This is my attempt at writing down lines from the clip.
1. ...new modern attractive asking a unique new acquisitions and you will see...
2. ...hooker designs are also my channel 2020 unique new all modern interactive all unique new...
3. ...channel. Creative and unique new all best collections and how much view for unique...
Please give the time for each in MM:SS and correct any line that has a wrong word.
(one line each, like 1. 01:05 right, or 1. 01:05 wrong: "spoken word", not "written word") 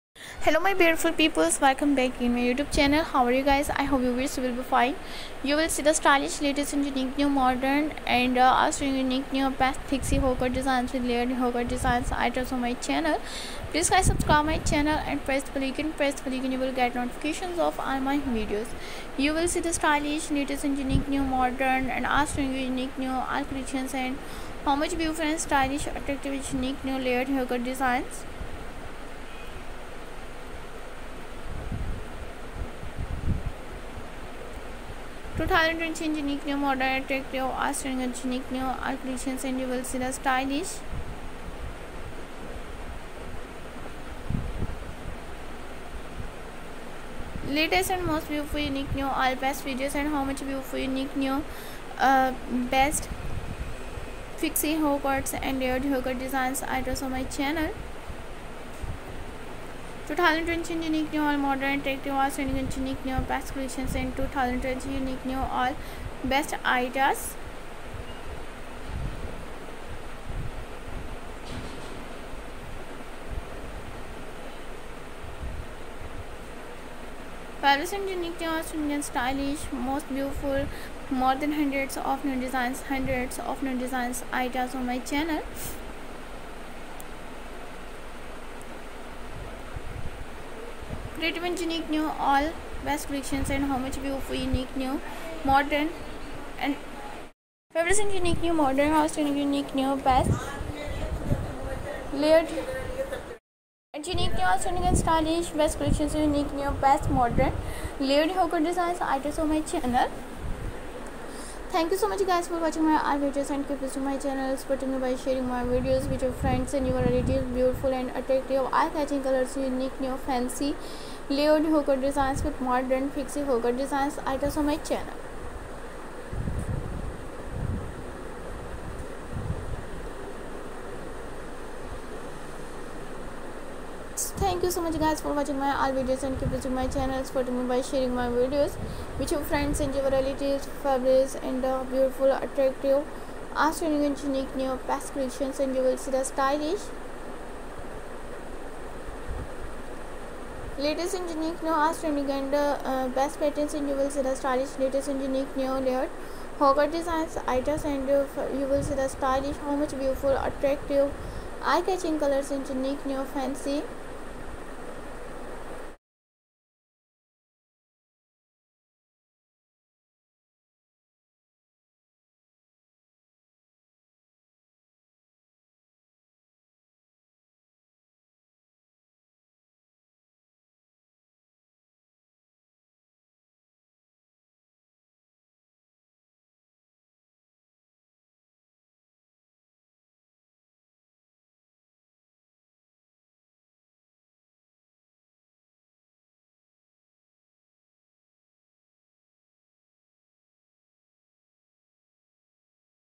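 1. 00:36 right
2. 00:55 right
3. 01:24 right.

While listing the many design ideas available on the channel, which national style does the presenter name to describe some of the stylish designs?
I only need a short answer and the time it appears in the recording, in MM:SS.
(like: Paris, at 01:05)
Indian, at 01:18.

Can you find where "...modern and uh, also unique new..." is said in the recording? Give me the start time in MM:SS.
00:07.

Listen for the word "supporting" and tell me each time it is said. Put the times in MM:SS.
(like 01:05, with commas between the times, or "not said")
01:54, 02:17.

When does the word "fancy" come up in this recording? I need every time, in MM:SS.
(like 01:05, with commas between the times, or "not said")
02:00, 02:43.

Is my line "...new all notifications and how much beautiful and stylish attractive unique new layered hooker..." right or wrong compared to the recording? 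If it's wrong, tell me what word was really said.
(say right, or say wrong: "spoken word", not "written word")
wrong: "creations", not "notifications".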